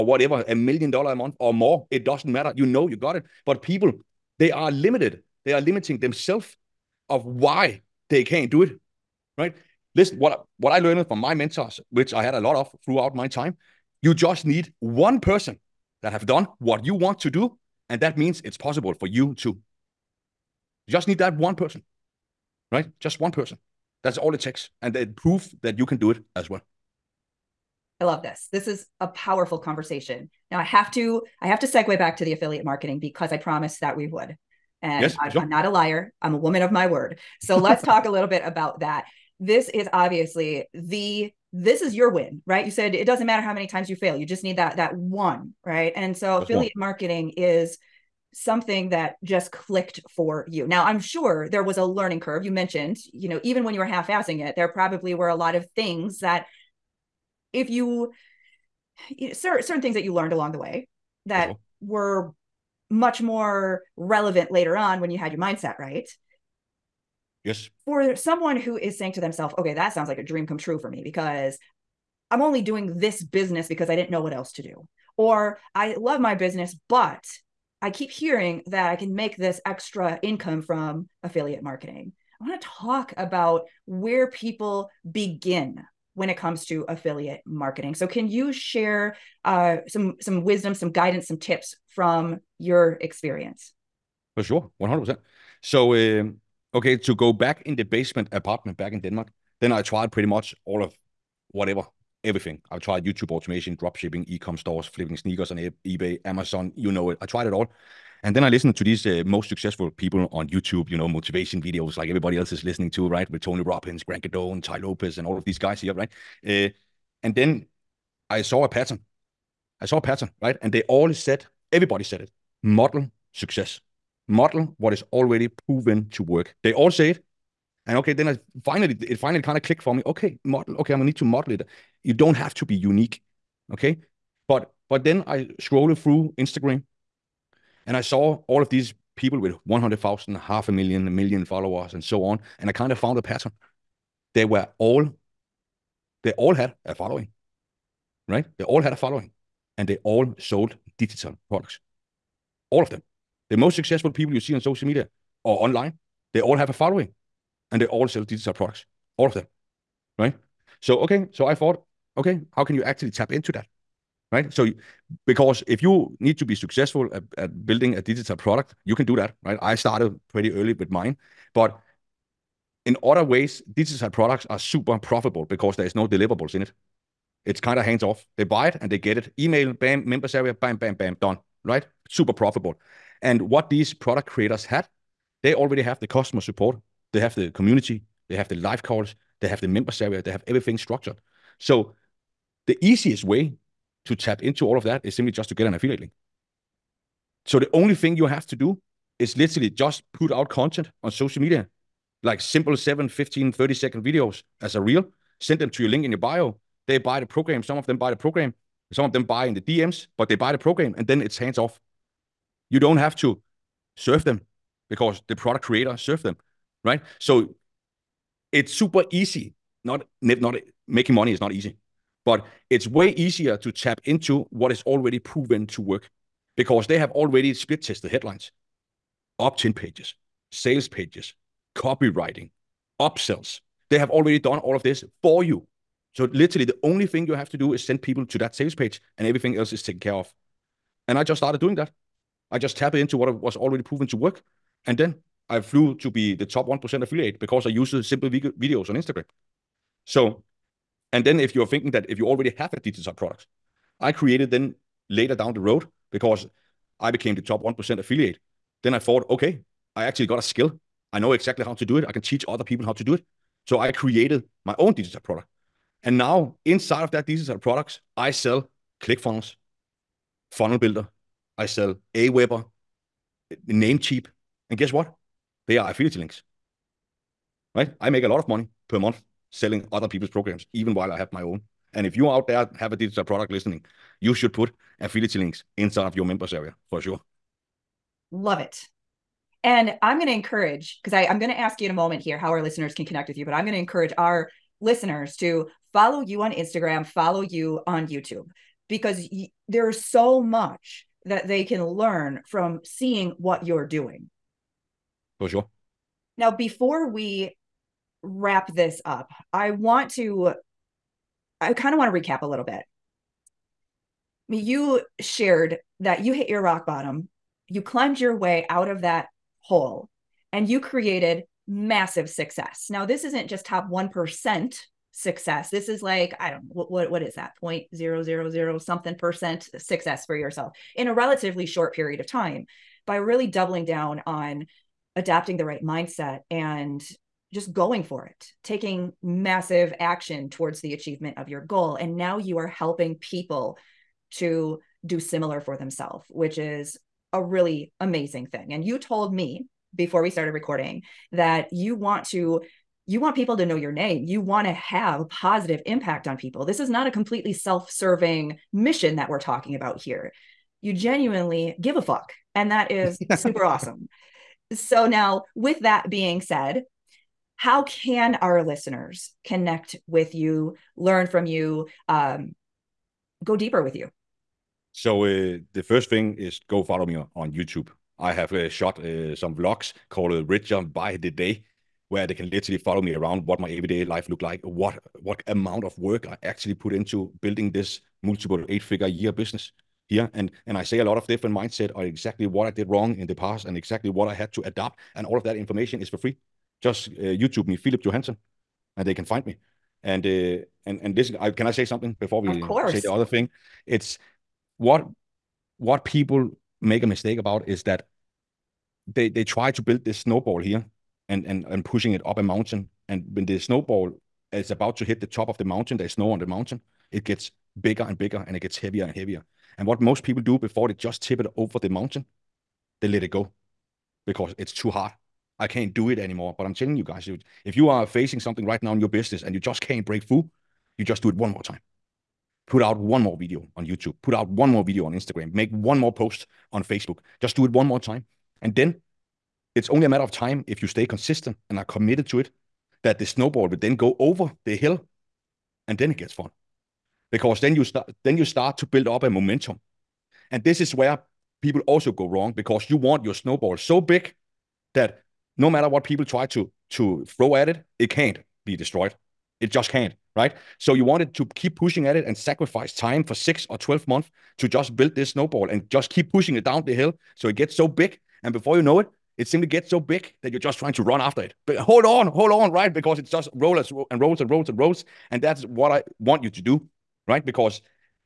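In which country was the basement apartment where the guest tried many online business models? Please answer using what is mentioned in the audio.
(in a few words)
Denmark.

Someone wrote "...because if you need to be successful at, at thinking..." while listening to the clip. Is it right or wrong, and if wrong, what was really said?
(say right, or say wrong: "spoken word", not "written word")
wrong: "building", not "thinking".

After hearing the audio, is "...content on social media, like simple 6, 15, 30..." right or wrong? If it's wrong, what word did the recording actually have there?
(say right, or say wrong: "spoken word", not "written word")
wrong: "7", not "6".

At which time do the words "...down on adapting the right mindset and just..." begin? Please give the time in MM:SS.
05:33.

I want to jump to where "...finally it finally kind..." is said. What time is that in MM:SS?
02:08.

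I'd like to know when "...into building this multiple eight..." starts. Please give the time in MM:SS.
06:26.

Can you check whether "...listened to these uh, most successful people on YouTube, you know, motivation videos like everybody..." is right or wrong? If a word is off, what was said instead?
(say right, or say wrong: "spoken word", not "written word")
right.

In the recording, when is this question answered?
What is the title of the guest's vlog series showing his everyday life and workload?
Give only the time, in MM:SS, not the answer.
06:20.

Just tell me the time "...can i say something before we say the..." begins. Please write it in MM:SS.
06:41.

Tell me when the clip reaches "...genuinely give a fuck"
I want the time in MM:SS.
06:00.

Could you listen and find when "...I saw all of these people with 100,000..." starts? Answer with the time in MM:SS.
02:17.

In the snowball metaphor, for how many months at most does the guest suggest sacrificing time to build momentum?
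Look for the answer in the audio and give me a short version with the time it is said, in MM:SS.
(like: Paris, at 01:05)
12 months, at 07:43.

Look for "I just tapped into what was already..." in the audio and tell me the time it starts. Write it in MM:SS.
04:02.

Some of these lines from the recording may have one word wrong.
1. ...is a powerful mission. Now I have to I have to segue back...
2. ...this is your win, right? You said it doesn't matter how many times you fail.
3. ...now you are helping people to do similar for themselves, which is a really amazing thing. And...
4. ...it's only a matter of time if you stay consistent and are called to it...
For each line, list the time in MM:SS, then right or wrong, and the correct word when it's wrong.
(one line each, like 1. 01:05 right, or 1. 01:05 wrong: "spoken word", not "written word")
1. 00:28 wrong: "conversation", not "mission"
2. 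00:41 right
3. 05:42 right
4. 07:19 wrong: "committed", not "called".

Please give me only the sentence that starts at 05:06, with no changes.
Now, before we wrap this up, I want to, I kind of want to recap a little bit.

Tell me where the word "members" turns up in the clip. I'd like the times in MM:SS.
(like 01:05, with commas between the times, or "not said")
03:00, 03:09, 04:46.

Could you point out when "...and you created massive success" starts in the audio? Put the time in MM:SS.
05:20.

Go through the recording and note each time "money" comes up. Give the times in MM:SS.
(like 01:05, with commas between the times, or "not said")
03:41, 04:38.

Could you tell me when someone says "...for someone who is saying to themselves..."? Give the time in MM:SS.
01:07.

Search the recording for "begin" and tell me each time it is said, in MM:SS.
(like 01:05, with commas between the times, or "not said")
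01:25.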